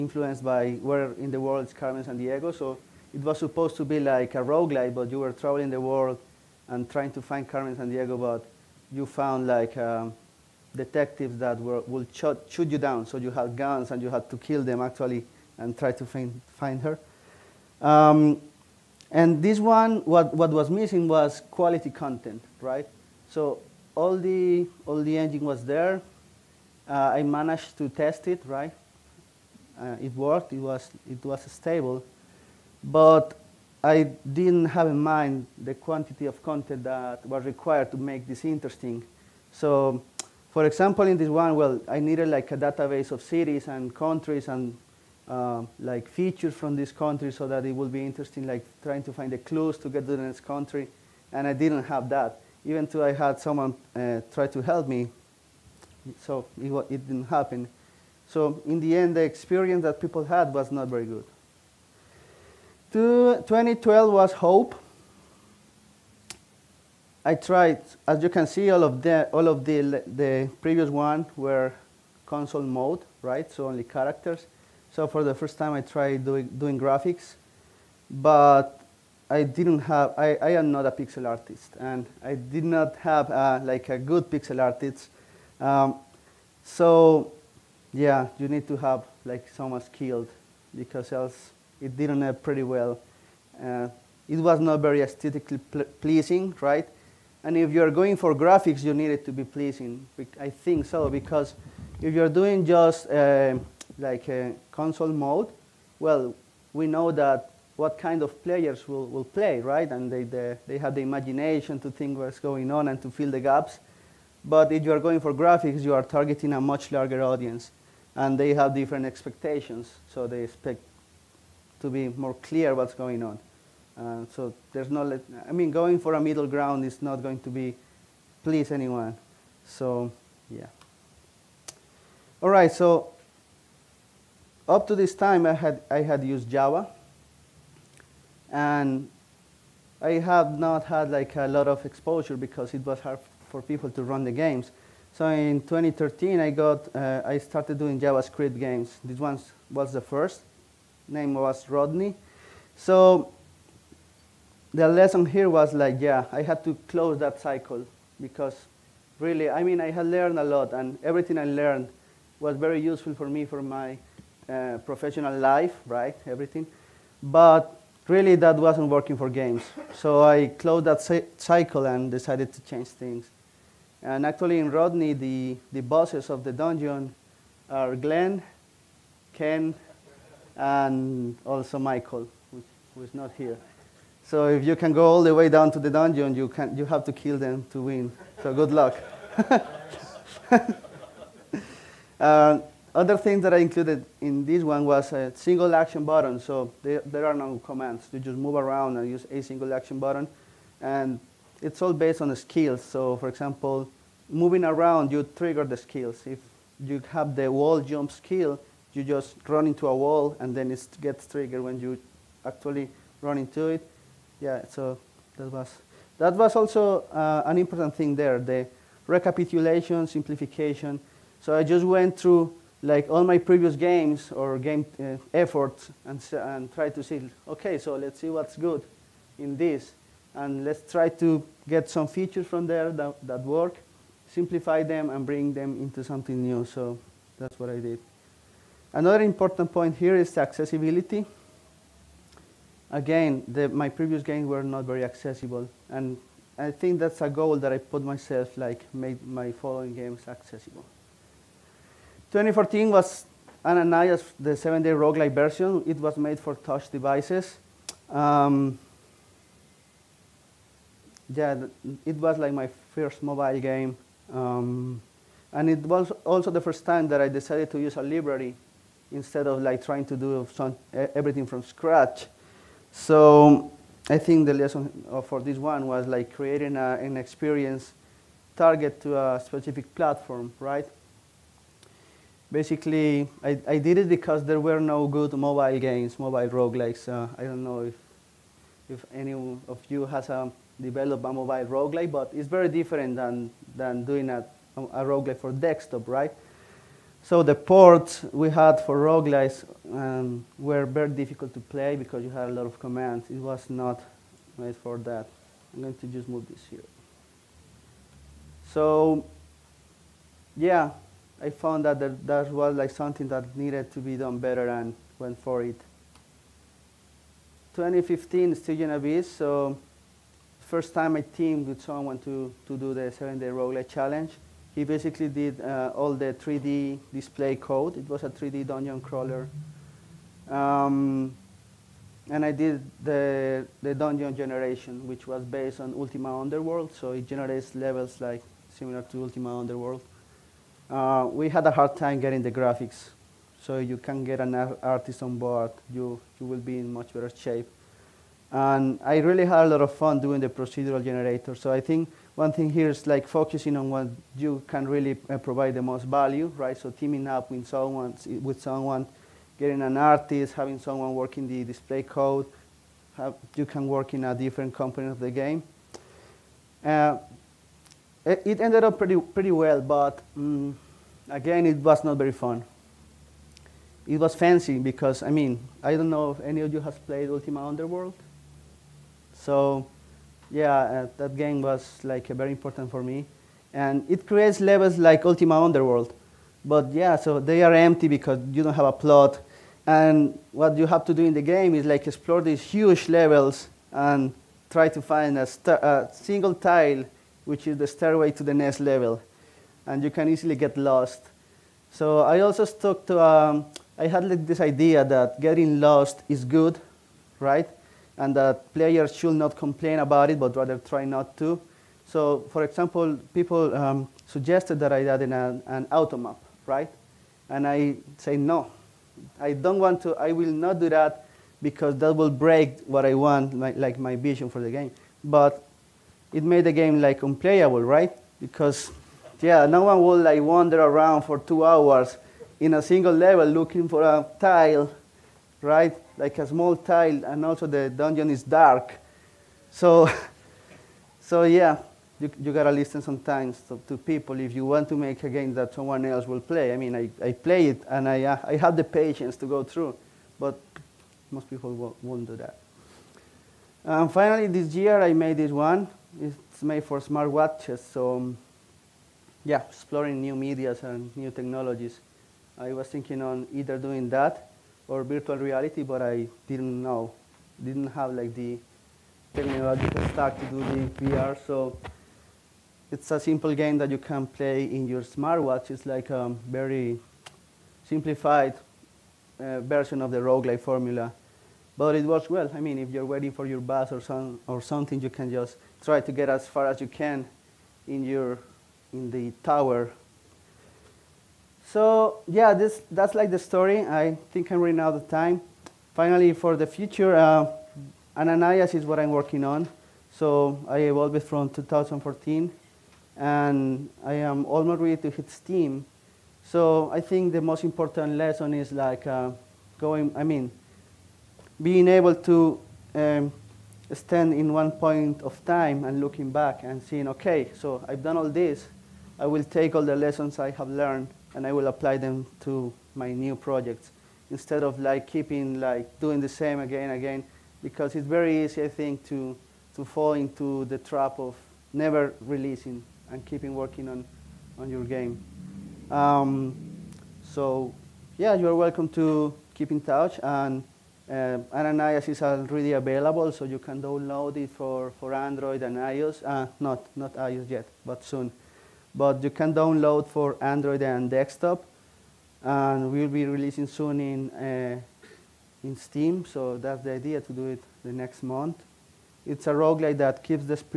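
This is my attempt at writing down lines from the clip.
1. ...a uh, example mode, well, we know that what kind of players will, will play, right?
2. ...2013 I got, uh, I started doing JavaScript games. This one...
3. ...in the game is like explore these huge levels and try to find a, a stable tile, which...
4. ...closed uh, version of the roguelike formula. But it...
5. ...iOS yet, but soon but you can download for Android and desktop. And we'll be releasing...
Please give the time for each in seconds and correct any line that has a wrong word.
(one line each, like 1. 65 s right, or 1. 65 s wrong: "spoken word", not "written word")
1. 104 s wrong: "console", not "example"
2. 145 s right
3. 391 s wrong: "single", not "stable"
4. 477 s wrong: "simplified", not "closed"
5. 547 s right.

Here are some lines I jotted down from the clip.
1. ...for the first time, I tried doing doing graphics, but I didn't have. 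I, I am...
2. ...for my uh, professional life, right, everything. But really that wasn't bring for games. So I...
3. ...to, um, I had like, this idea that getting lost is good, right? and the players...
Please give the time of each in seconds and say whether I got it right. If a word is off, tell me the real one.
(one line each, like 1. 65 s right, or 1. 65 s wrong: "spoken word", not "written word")
1. 75 s right
2. 163 s wrong: "working", not "bring"
3. 403 s right.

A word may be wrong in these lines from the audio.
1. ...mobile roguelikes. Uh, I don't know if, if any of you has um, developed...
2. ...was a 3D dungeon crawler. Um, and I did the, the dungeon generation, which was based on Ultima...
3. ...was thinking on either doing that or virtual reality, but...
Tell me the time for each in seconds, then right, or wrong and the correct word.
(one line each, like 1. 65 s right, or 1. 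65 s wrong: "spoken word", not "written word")
1. 286 s right
2. 328 s right
3. 462 s right.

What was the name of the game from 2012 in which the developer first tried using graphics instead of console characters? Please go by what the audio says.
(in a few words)
Hope.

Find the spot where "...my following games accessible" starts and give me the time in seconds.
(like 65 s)
249 s.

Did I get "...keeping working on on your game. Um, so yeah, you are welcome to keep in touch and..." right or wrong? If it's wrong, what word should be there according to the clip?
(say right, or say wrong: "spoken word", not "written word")
right.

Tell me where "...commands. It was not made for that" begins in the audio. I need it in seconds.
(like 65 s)
302 s.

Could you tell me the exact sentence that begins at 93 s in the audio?
Uh, it was not very aesthetically pl pleasing, right?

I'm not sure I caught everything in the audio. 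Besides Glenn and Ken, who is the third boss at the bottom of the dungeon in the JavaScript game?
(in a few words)
Michael.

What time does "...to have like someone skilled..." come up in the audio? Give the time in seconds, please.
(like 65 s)
88 s.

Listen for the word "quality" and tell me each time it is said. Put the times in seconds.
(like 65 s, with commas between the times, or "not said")
21 s.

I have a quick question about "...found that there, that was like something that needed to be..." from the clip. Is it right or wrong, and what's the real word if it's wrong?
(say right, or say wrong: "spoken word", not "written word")
right.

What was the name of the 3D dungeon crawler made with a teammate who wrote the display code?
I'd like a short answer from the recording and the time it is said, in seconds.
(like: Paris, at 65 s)
Stygian Abyss, at 318 s.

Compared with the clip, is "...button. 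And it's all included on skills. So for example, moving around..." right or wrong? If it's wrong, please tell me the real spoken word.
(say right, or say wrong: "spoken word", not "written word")
wrong: "based", not "included".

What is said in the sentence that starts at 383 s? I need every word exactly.
And it creates levels like Ultima Underworld.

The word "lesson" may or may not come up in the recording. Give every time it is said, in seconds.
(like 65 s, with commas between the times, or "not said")
154 s, 274 s, 508 s, 519 s.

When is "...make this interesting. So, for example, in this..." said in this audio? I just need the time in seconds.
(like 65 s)
37 s.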